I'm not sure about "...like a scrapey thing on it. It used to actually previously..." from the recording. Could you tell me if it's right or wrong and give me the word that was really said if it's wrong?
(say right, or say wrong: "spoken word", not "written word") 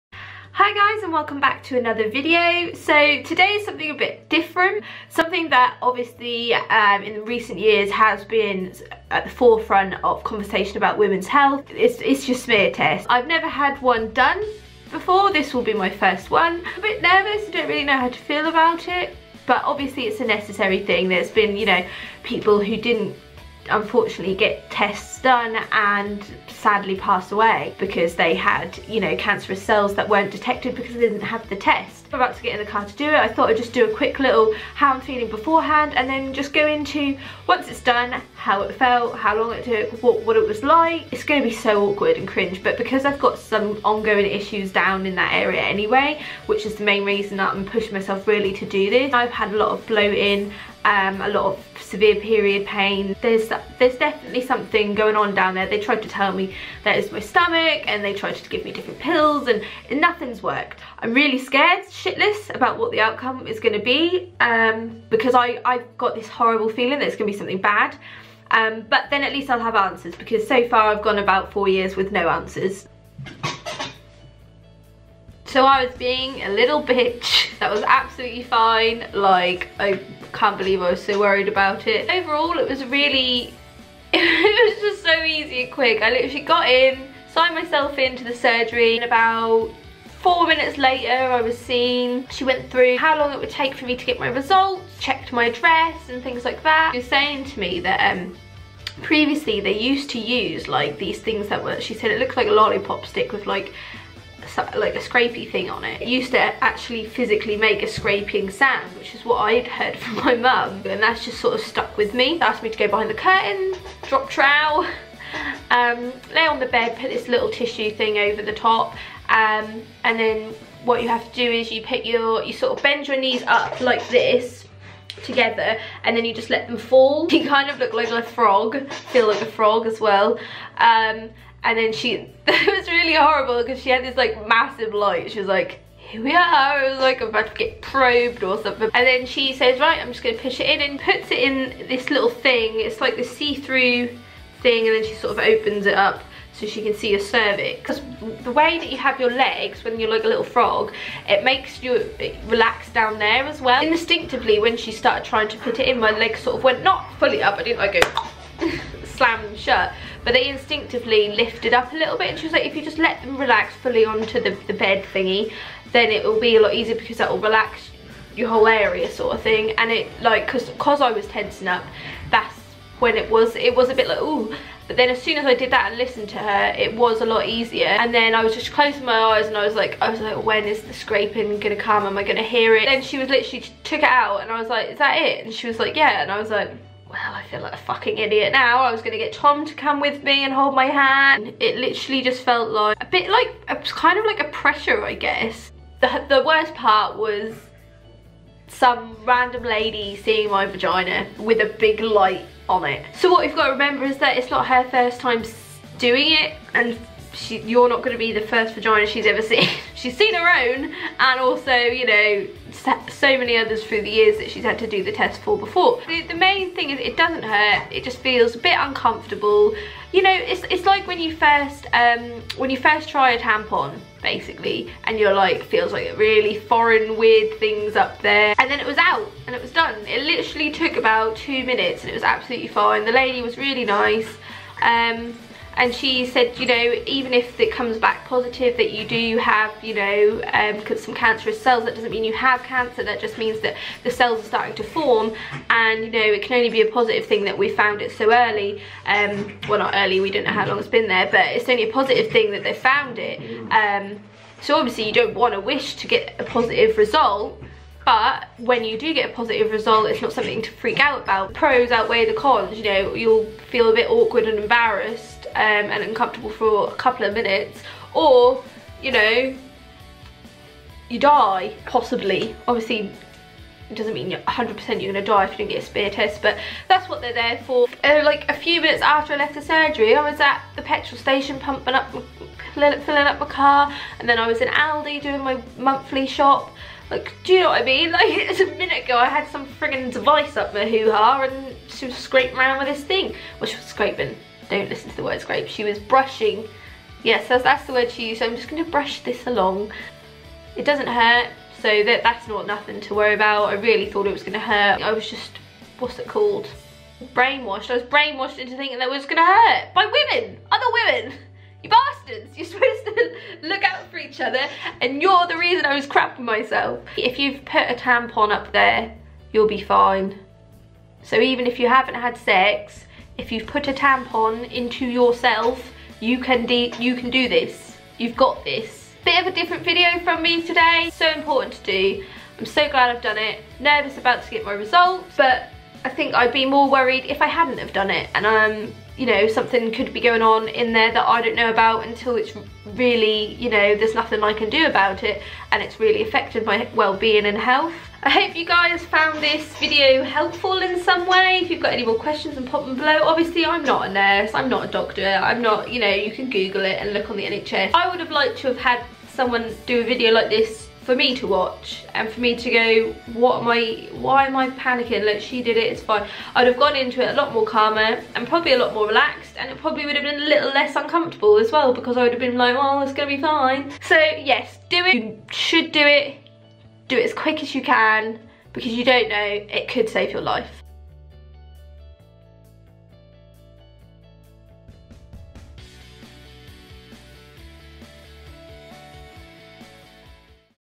wrong: "physically", not "previously".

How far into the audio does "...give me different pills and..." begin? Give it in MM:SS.
00:58.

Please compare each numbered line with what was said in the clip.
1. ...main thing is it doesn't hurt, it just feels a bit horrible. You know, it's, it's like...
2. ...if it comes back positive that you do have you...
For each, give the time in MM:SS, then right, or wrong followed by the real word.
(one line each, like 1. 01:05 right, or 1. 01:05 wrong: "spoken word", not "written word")
1. 03:36 wrong: "uncomfortable", not "horrible"
2. 03:57 right.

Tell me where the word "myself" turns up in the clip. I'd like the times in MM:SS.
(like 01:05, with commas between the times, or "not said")
00:47, 01:27, 05:16.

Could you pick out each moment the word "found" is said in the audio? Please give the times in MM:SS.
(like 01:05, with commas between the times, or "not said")
04:07, 04:12, 05:49.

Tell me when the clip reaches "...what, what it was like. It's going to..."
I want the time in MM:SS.
00:40.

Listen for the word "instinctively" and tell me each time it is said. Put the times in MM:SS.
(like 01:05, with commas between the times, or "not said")
02:33, 02:40.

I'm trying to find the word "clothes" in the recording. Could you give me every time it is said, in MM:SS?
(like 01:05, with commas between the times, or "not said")
not said.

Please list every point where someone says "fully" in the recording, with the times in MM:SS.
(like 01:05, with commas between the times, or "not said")
02:37, 02:43.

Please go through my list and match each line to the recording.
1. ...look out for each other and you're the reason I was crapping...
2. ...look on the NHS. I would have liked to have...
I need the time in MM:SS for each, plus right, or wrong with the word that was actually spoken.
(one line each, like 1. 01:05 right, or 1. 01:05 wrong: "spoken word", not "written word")
1. 05:13 right
2. 05:57 right.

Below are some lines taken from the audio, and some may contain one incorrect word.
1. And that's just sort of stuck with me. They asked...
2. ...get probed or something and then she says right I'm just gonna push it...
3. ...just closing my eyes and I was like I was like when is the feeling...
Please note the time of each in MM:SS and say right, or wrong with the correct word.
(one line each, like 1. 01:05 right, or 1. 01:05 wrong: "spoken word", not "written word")
1. 01:50 right
2. 02:17 right
3. 02:58 wrong: "scraping", not "feeling".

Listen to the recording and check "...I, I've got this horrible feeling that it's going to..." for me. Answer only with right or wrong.
right.